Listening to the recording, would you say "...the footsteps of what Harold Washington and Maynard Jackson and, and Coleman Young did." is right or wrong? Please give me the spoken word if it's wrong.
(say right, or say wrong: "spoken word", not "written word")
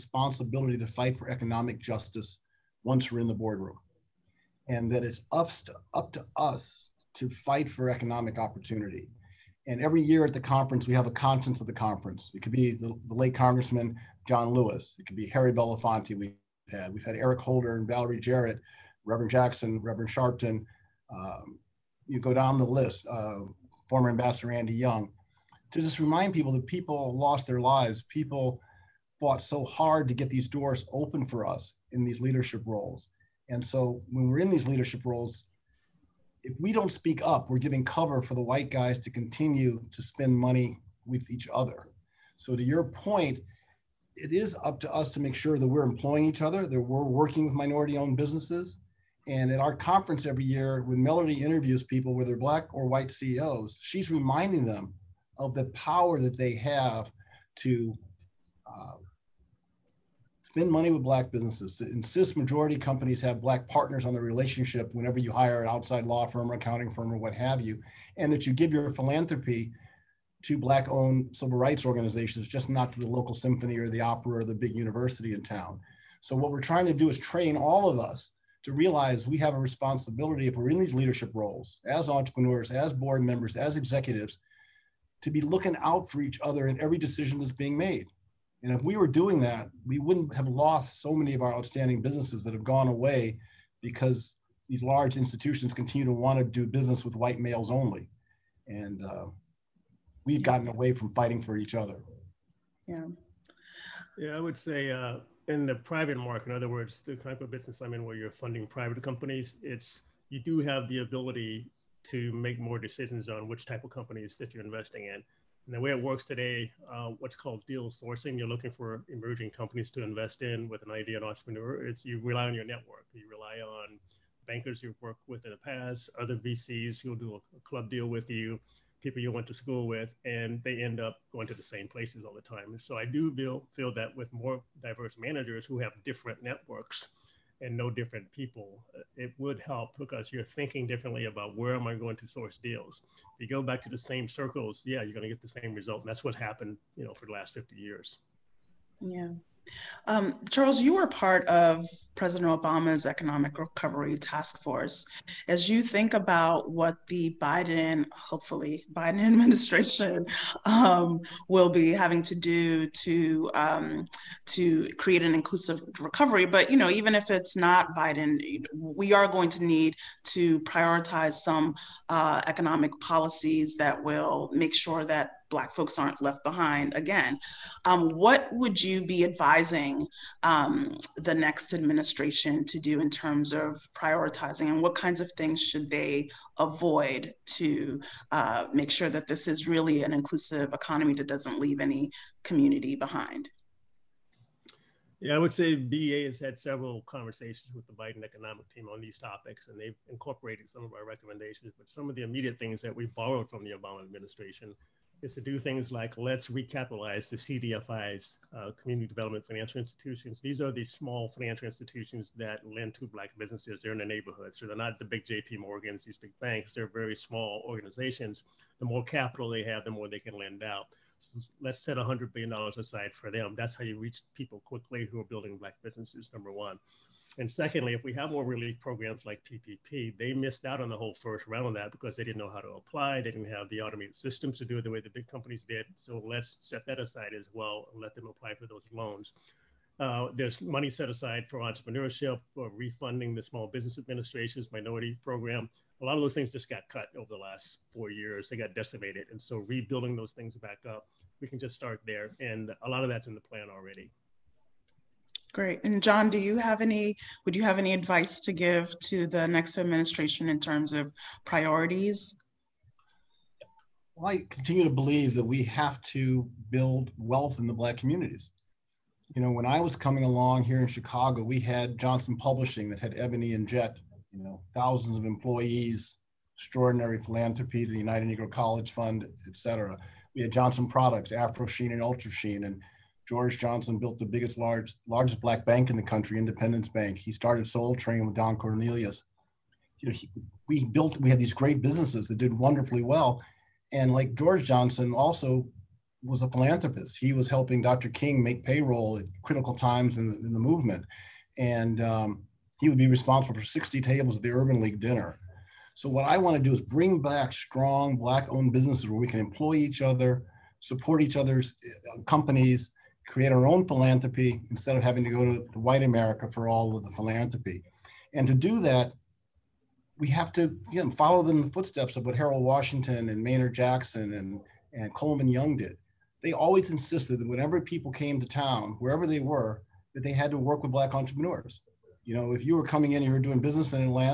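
right.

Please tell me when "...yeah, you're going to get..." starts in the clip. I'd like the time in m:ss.
2:24.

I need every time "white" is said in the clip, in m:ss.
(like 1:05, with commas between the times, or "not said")
0:38, 0:52, 1:37, 5:15.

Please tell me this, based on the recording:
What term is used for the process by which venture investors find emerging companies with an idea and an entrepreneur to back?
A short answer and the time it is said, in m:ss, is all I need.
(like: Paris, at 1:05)
deal sourcing, at 1:57.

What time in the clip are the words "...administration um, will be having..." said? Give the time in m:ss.
2:39.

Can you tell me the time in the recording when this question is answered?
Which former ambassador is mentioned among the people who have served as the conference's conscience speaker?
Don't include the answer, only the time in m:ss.
0:24.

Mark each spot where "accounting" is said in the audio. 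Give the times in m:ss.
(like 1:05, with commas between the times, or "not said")
1:06.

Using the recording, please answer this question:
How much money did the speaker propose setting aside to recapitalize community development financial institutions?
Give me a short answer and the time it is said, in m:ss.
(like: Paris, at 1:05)
$100 billion, at 3:41.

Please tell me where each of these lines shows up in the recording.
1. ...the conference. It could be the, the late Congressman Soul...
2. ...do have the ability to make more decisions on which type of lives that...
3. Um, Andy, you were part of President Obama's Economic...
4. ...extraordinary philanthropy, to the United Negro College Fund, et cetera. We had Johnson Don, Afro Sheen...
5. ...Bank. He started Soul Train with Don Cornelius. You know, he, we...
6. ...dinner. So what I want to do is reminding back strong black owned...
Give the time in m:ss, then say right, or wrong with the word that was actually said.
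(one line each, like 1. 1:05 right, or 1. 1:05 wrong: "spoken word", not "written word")
1. 0:11 wrong: "John", not "Soul"
2. 1:50 wrong: "companies", not "lives"
3. 2:30 wrong: "Charles", not "Andy"
4. 4:36 wrong: "Products", not "Don"
5. 4:46 right
6. 5:04 wrong: "bring", not "reminding".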